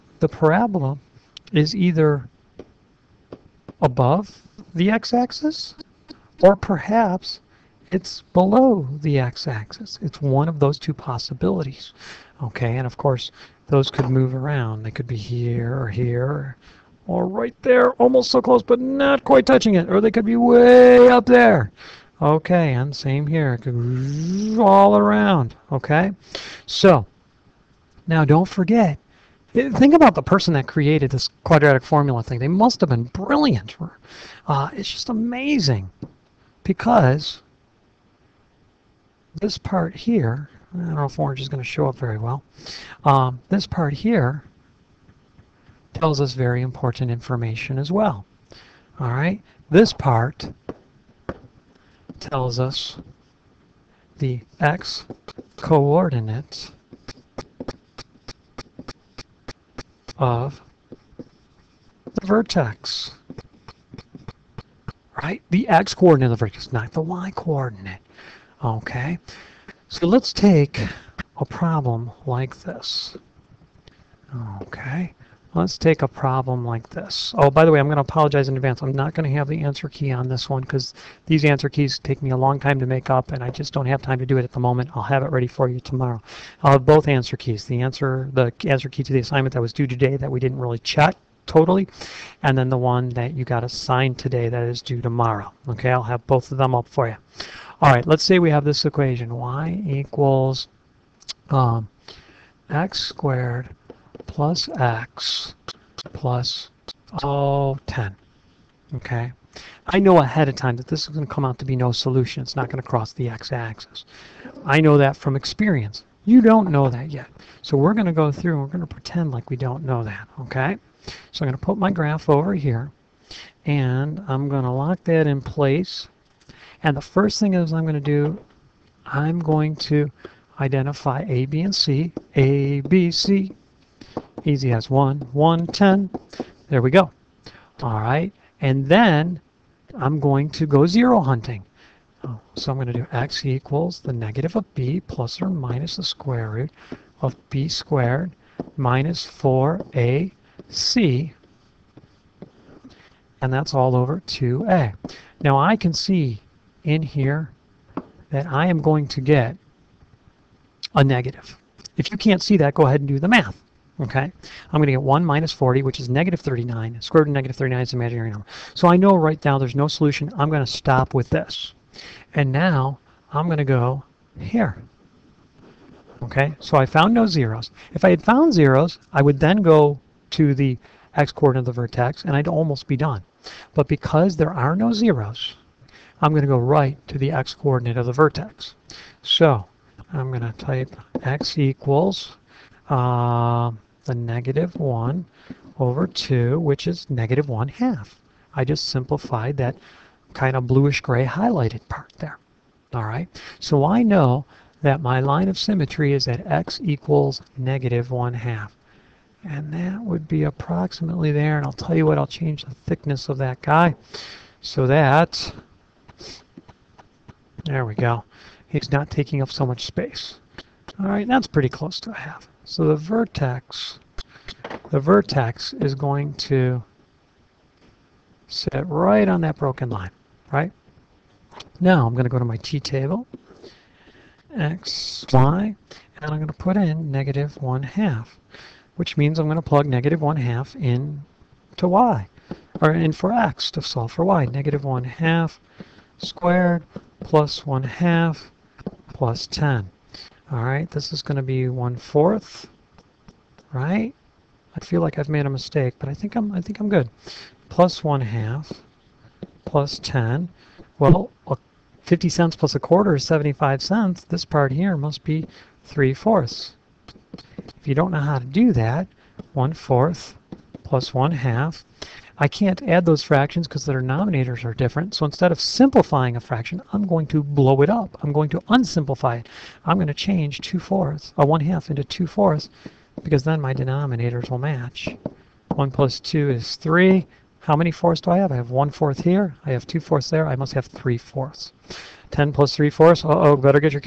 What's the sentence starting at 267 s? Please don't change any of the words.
If you don't know how to do that, 1 fourth plus 1 half.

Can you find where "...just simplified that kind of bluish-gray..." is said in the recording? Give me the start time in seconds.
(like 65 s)
198 s.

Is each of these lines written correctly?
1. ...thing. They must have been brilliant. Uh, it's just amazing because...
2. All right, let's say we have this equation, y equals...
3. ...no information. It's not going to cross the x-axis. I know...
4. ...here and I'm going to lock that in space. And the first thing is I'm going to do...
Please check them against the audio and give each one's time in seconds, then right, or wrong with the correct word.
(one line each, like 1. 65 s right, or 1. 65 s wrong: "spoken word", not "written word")
1. 32 s right
2. 97 s right
3. 111 s wrong: "solution", not "information"
4. 122 s wrong: "place", not "space".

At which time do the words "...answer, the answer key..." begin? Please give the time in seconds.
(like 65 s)
87 s.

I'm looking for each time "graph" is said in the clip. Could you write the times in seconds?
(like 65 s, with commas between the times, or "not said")
121 s.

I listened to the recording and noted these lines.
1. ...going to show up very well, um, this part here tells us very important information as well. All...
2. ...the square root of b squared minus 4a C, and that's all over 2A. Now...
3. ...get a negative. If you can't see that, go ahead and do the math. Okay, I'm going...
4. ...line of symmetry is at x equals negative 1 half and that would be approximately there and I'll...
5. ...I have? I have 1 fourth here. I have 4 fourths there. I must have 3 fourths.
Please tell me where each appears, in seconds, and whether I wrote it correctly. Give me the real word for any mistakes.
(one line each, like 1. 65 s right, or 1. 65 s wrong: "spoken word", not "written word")
1. 41 s right
2. 145 s right
3. 159 s right
4. 205 s right
5. 288 s wrong: "2", not "4".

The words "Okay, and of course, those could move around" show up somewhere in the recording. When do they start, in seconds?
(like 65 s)
12 s.